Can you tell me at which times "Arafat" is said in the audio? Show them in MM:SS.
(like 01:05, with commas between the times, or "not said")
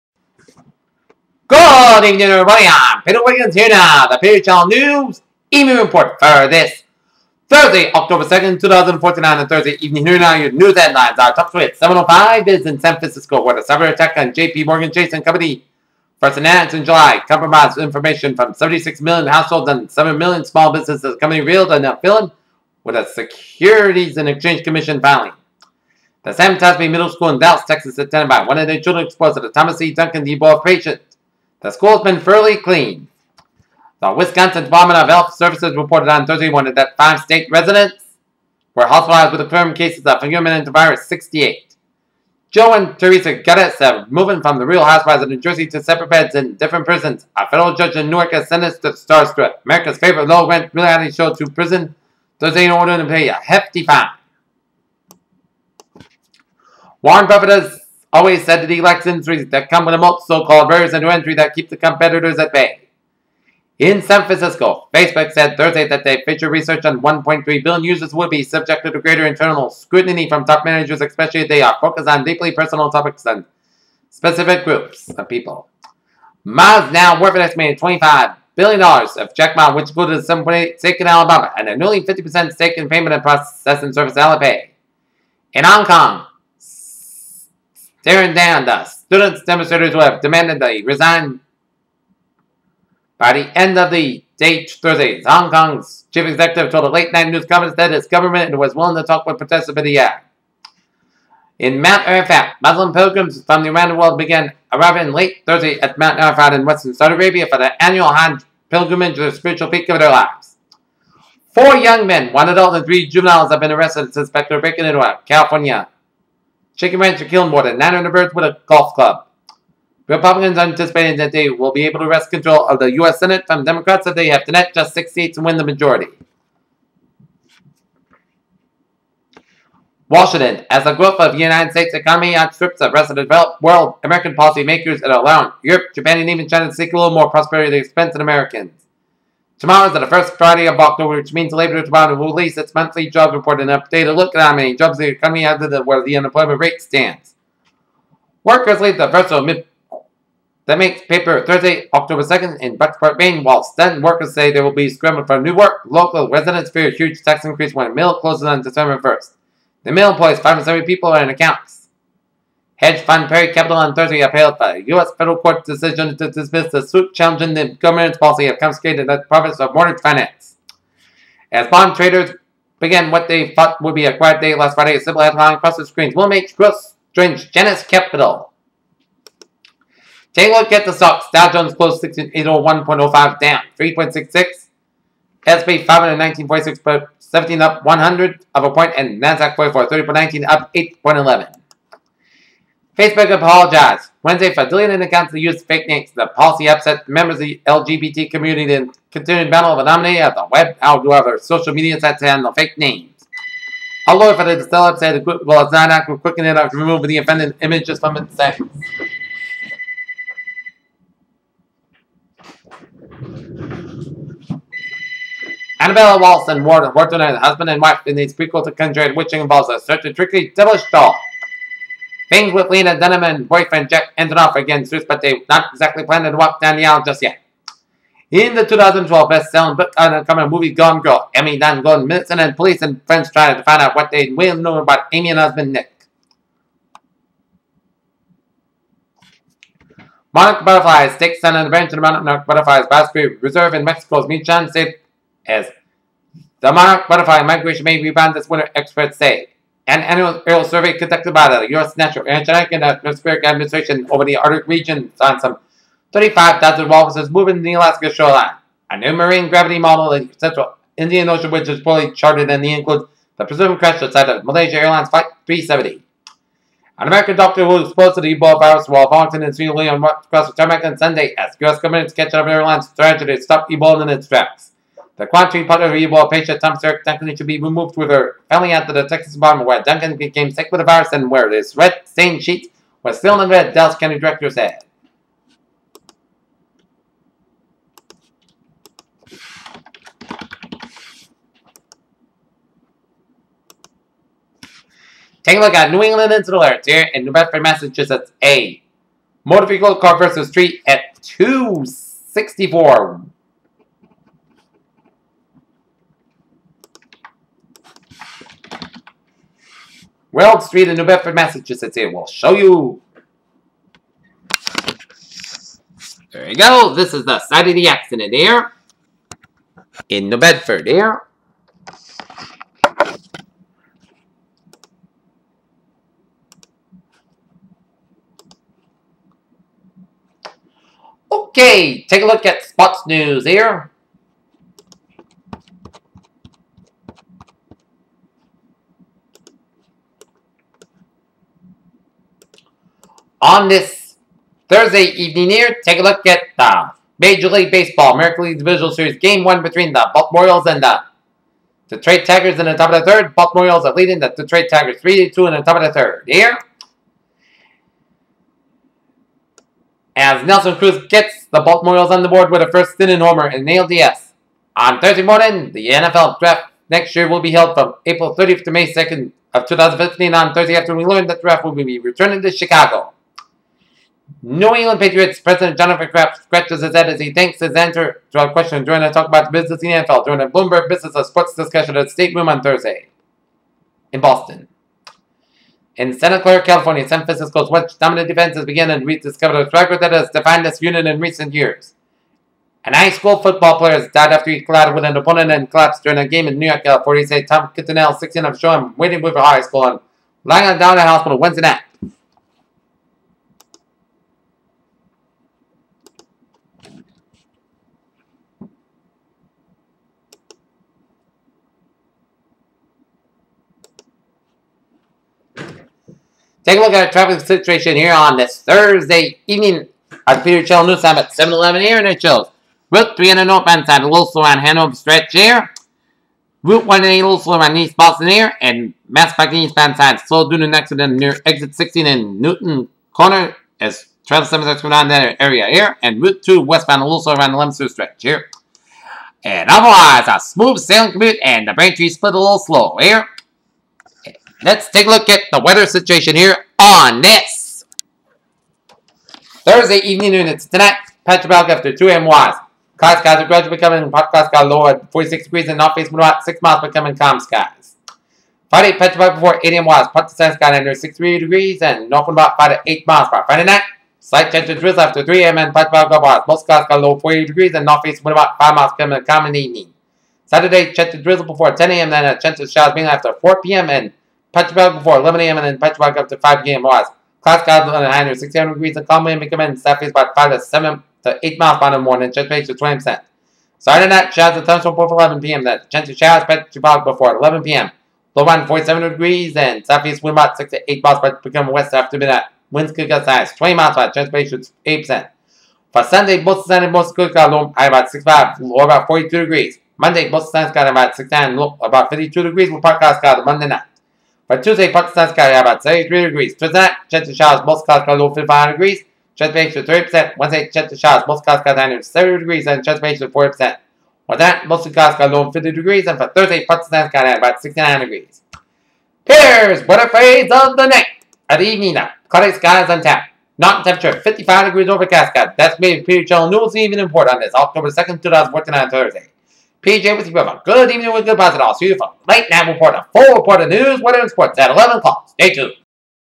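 01:42, 01:46.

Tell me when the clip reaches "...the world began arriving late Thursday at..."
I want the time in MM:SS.
01:43.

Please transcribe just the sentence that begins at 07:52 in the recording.
Then a chance of showers being after 4 p.m.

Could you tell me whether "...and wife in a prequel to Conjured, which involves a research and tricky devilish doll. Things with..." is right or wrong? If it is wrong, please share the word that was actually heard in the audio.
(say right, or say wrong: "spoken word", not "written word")
wrong: "search", not "research".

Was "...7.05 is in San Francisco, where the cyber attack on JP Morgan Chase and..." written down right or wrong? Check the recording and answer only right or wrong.
right.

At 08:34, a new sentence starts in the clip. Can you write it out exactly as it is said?
For that, most of clouds cut low 50 degrees and for Thursday, Pakistan's current about 69 degrees.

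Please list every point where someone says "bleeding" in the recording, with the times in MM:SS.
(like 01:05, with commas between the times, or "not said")
not said.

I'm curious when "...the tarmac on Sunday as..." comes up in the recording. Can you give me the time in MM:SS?
04:30.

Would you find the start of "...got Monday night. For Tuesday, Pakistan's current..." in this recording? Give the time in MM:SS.
08:23.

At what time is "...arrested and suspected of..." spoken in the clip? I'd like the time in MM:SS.
01:53.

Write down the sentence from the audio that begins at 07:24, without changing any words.
Let's take a look at the weather situation here on this Thursday evening units.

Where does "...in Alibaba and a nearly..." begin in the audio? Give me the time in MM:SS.
01:20.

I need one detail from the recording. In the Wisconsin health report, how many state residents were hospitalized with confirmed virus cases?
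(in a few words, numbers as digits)
5.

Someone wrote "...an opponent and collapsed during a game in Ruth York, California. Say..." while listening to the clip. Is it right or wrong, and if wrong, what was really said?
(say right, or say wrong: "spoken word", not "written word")
wrong: "New", not "Ruth".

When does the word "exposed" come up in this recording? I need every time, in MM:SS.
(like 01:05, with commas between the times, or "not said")
00:29, 04:27.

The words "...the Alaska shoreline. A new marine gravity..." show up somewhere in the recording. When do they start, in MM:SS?
04:17.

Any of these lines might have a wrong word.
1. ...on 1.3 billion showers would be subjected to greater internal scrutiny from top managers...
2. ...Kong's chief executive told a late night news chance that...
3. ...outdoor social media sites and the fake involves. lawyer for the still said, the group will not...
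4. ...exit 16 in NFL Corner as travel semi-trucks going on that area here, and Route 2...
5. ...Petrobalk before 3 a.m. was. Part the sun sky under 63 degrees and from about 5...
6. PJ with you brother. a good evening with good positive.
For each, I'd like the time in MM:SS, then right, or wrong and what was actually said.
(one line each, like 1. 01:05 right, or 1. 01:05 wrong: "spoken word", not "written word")
1. 01:06 wrong: "users", not "showers"
2. 01:35 wrong: "conference", not "chance"
3. 03:20 wrong: "names", not "involves"
4. 07:11 wrong: "Newton", not "NFL"
5. 07:38 wrong: "8", not "3"
6. 08:49 right.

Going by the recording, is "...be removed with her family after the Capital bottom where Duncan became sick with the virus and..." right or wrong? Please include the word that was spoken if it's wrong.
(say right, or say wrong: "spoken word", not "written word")
wrong: "Texas", not "Capital".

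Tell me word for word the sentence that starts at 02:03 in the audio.
Senate from Democrats if they have to net just six seats and win the majority.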